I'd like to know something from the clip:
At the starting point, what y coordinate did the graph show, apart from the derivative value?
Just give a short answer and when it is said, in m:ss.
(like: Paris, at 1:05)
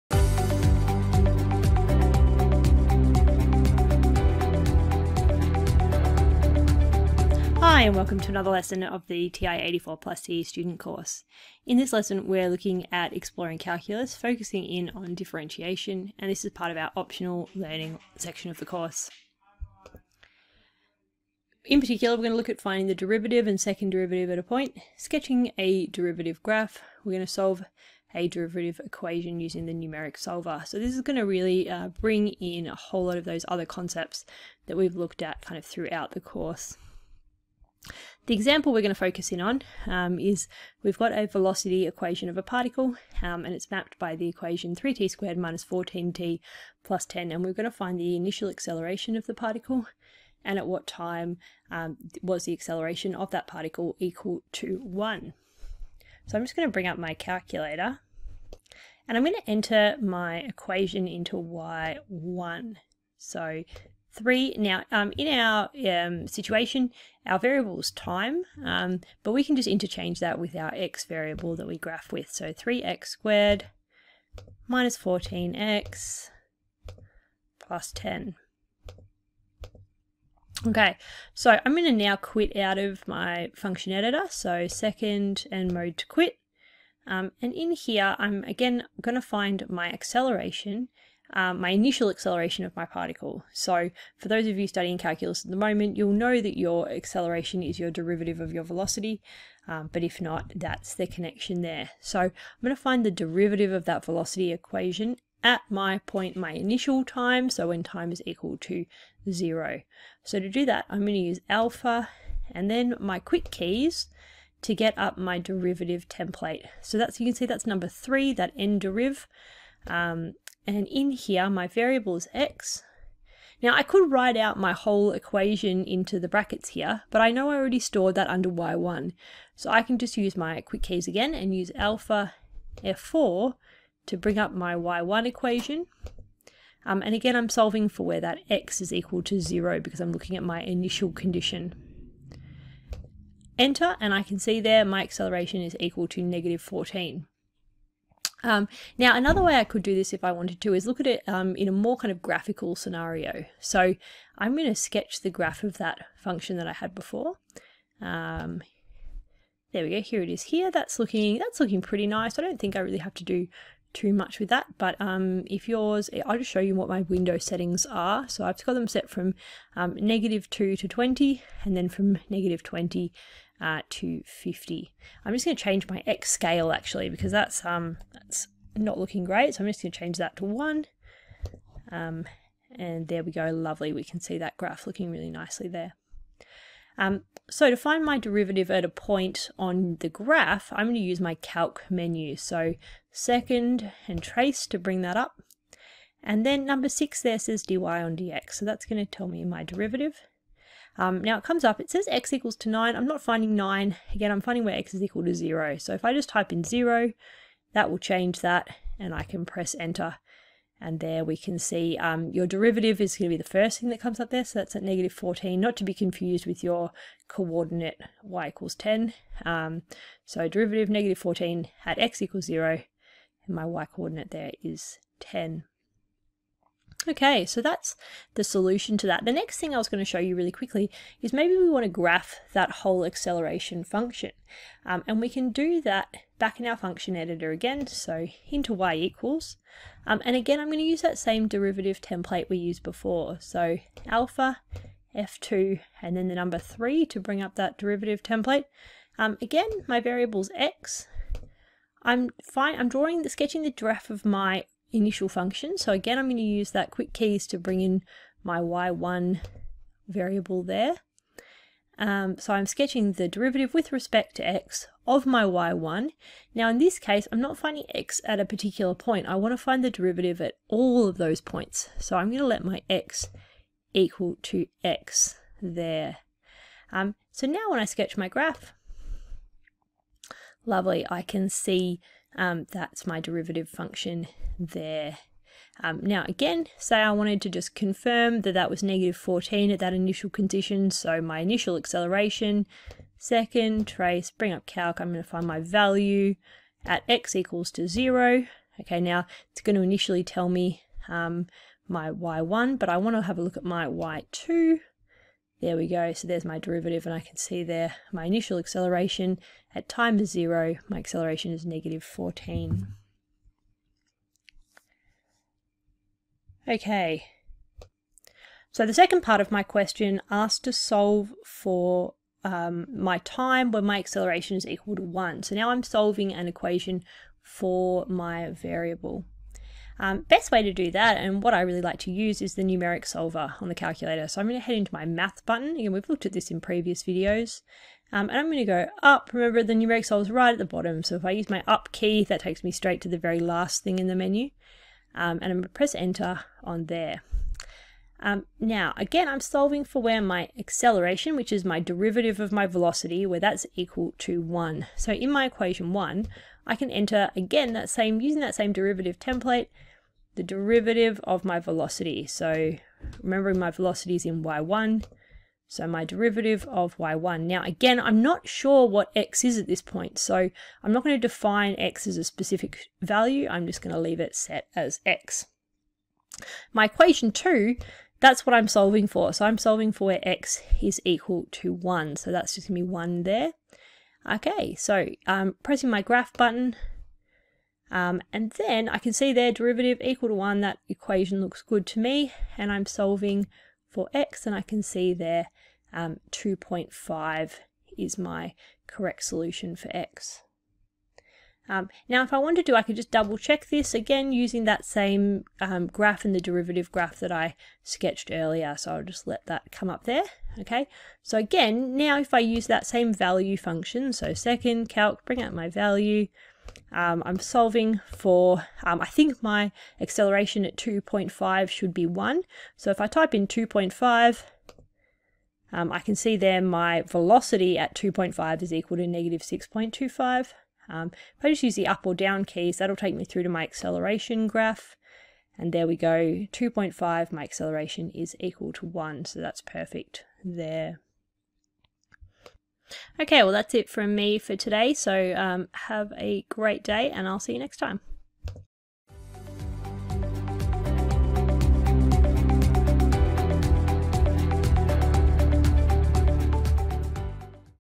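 10, at 3:43.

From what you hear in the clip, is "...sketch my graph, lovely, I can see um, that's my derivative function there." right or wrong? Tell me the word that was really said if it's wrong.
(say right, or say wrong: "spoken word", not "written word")
right.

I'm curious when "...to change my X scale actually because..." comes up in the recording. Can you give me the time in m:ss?
2:55.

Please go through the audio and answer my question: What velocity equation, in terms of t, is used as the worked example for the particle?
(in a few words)
3t squared minus 14t plus 10.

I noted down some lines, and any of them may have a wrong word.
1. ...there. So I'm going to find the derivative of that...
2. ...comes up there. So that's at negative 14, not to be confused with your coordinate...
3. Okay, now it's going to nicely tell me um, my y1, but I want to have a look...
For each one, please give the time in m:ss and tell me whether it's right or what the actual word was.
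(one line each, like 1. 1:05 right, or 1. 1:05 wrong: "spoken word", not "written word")
1. 1:41 right
2. 3:33 right
3. 4:58 wrong: "initially", not "nicely".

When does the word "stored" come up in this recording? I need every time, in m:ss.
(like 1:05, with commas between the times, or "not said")
2:07.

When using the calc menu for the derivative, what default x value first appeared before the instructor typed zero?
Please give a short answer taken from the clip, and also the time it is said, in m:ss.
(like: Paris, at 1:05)
9, at 3:22.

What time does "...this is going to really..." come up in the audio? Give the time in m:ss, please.
0:30.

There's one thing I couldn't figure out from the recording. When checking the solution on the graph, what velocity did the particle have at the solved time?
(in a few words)
-6.25.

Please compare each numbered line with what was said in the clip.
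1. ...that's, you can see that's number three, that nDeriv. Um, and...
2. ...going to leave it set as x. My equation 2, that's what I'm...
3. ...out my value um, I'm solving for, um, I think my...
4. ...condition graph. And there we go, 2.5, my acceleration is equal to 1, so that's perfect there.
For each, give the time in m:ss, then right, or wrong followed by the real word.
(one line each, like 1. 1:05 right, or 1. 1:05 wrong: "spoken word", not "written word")
1. 1:56 right
2. 6:13 right
3. 6:55 right
4. 7:13 wrong: "acceleration", not "condition".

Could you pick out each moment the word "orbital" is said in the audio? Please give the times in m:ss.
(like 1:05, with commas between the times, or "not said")
not said.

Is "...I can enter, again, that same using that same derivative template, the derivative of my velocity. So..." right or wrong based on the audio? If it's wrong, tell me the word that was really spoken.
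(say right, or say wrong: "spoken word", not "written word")
right.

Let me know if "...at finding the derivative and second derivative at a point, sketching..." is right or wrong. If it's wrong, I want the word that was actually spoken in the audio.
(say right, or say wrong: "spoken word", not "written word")
right.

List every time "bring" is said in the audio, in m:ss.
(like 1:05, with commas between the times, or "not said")
0:31, 0:56, 2:14, 3:14, 4:07, 4:17, 4:54, 6:55.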